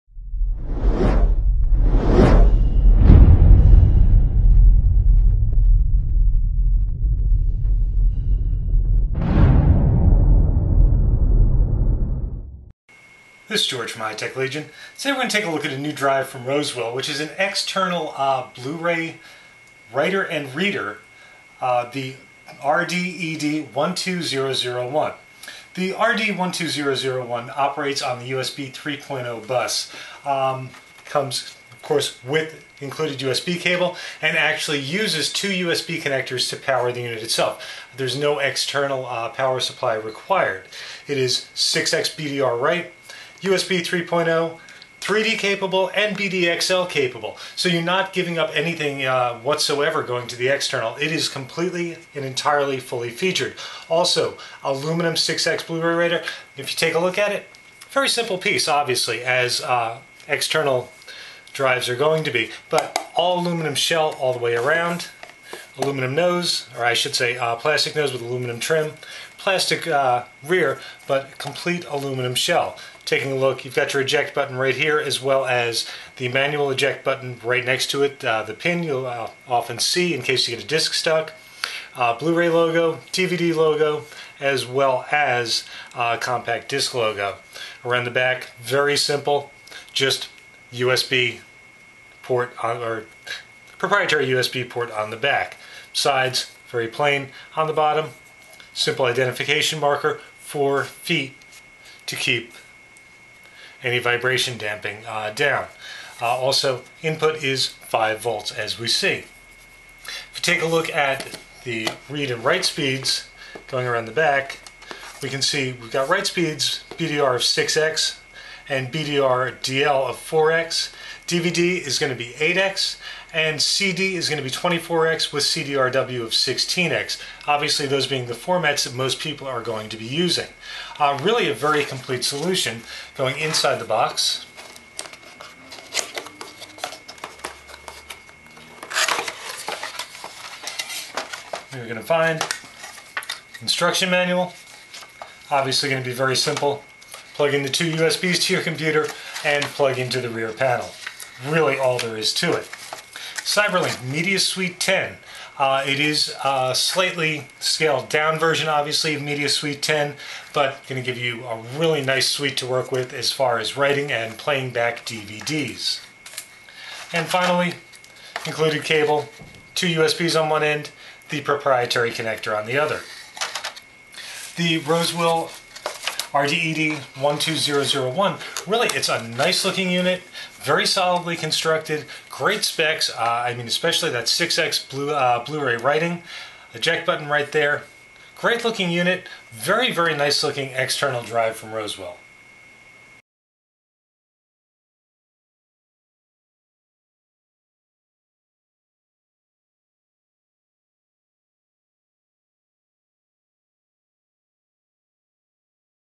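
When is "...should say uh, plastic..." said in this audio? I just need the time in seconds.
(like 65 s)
66 s.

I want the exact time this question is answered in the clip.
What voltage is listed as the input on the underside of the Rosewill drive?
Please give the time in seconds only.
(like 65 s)
107 s.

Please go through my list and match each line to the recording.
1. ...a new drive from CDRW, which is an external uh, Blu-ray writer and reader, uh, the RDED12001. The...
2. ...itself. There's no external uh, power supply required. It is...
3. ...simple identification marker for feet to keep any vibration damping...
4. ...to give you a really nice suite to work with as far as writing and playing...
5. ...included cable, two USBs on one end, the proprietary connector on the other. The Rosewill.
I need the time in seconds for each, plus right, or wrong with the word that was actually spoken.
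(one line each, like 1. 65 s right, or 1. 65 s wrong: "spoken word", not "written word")
1. 15 s wrong: "Rosewill", not "CDRW"
2. 37 s right
3. 98 s right
4. 161 s right
5. 168 s right.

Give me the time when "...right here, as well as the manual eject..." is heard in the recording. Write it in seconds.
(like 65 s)
74 s.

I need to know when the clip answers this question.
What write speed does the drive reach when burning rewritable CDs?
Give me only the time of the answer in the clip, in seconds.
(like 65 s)
126 s.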